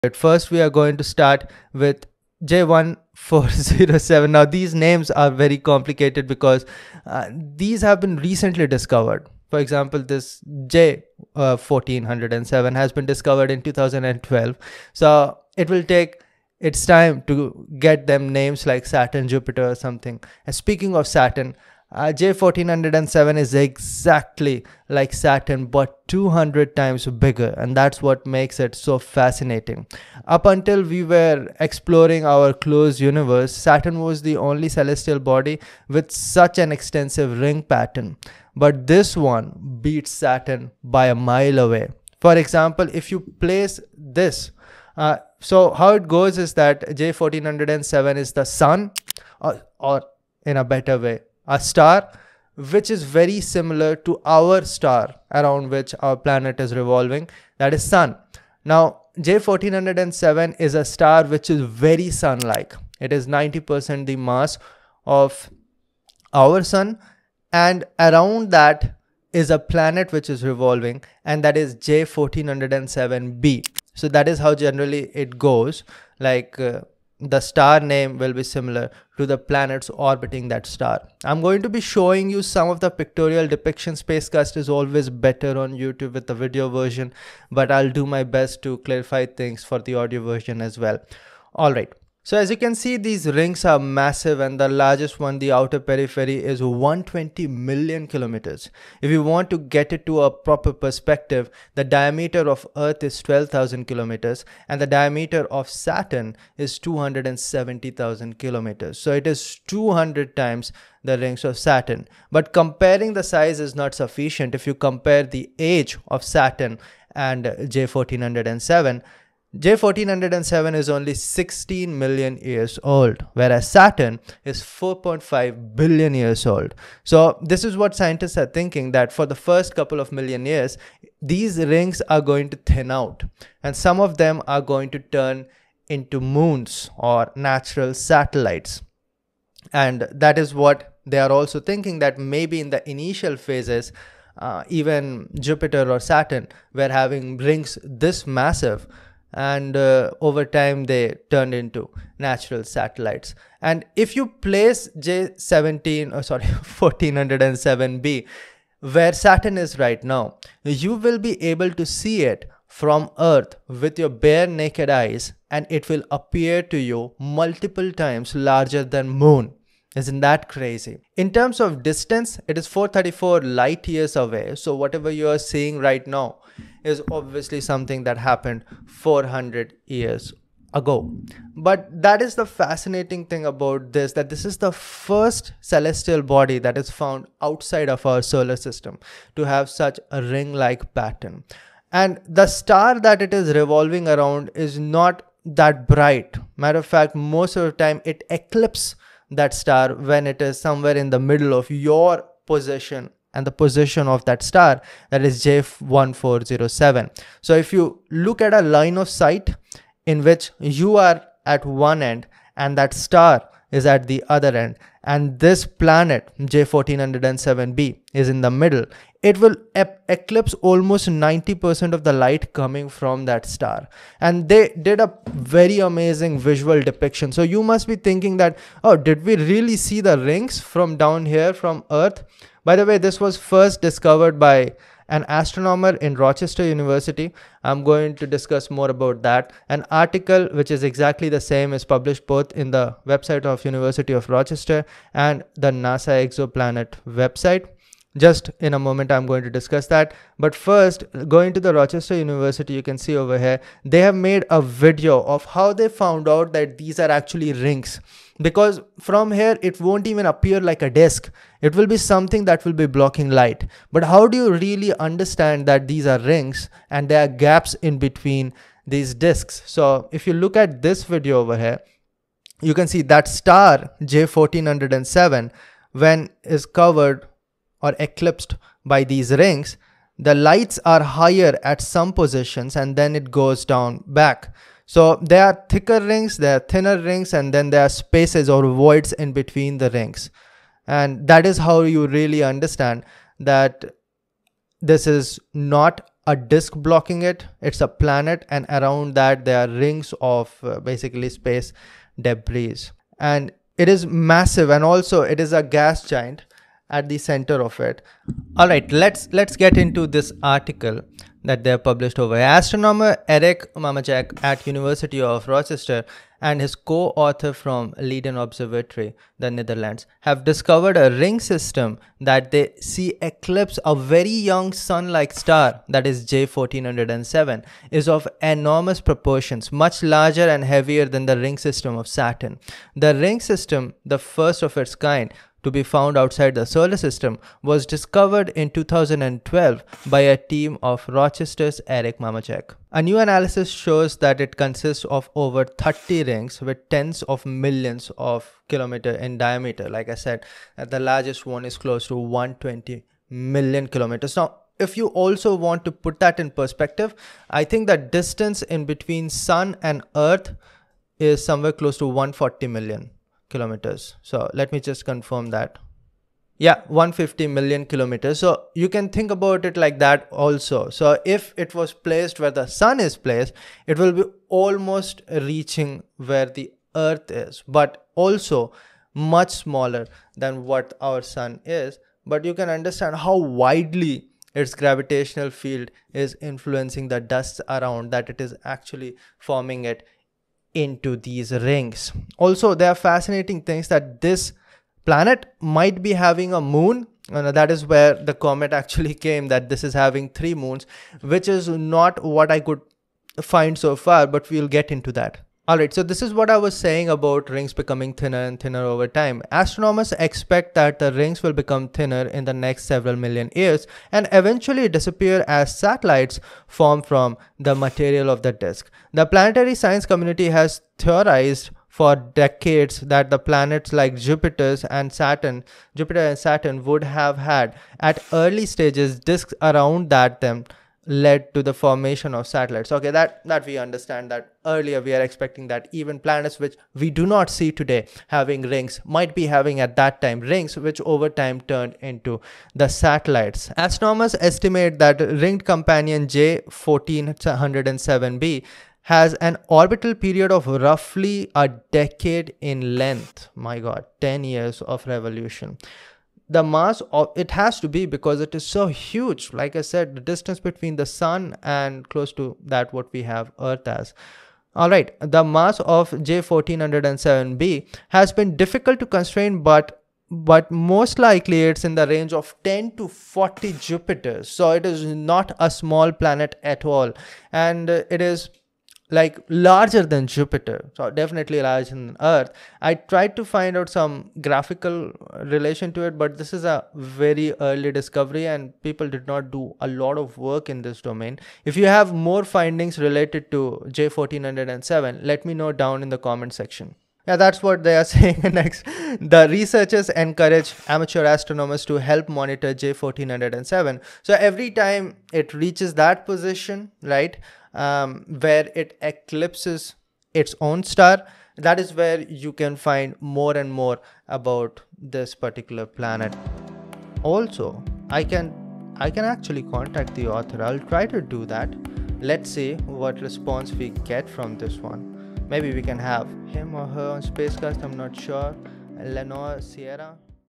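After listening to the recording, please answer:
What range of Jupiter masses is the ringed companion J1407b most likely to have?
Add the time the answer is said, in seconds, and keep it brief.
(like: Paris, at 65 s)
10 to 40 Jupiters, at 472 s.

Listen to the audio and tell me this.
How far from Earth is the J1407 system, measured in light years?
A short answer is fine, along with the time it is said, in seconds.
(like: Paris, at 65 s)
434 light years, at 172 s.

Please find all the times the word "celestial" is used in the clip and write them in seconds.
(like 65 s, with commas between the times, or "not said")
34 s, 185 s.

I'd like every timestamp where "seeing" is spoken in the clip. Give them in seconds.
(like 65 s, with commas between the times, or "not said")
175 s.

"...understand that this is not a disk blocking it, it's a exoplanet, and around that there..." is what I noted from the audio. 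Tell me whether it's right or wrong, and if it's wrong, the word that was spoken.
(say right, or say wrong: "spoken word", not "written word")
wrong: "planet", not "exoplanet".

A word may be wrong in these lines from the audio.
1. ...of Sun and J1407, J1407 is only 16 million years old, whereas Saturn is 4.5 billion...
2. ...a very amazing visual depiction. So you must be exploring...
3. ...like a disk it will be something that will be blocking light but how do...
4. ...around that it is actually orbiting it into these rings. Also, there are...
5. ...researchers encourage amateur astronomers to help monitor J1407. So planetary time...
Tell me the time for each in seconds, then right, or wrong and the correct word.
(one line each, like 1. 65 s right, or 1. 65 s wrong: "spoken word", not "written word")
1. 116 s wrong: "Saturn", not "Sun"
2. 224 s wrong: "thinking", not "exploring"
3. 260 s right
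4. 387 s wrong: "forming", not "orbiting"
5. 499 s wrong: "every", not "planetary".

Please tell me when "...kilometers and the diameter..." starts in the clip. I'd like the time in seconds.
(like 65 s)
103 s.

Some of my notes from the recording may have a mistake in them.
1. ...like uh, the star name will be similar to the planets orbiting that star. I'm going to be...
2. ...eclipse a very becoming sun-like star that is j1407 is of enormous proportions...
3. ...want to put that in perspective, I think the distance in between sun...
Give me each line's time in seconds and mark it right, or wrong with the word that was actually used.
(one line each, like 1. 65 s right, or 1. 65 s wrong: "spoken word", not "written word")
1. 76 s right
2. 323 s wrong: "young", not "becoming"
3. 355 s right.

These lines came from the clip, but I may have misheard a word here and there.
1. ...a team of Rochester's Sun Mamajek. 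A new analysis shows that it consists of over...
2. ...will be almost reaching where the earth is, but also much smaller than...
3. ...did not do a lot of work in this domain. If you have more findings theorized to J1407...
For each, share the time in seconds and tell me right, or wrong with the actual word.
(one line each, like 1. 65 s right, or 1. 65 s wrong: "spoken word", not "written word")
1. 340 s wrong: "Eric", not "Sun"
2. 373 s right
3. 489 s wrong: "related", not "theorized".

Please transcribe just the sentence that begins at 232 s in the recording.
By the way, this was first discovered by an astronomer in Rochester University.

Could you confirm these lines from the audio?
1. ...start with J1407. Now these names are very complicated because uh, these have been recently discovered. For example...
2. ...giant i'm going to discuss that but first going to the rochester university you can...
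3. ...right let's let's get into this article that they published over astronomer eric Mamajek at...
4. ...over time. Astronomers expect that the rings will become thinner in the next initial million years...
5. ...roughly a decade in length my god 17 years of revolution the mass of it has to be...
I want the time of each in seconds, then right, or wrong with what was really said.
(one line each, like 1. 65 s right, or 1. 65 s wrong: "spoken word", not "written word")
1. 1 s right
2. 248 s wrong: "moment", not "giant"
3. 308 s right
4. 408 s wrong: "several", not "initial"
5. 450 s wrong: "10", not "17".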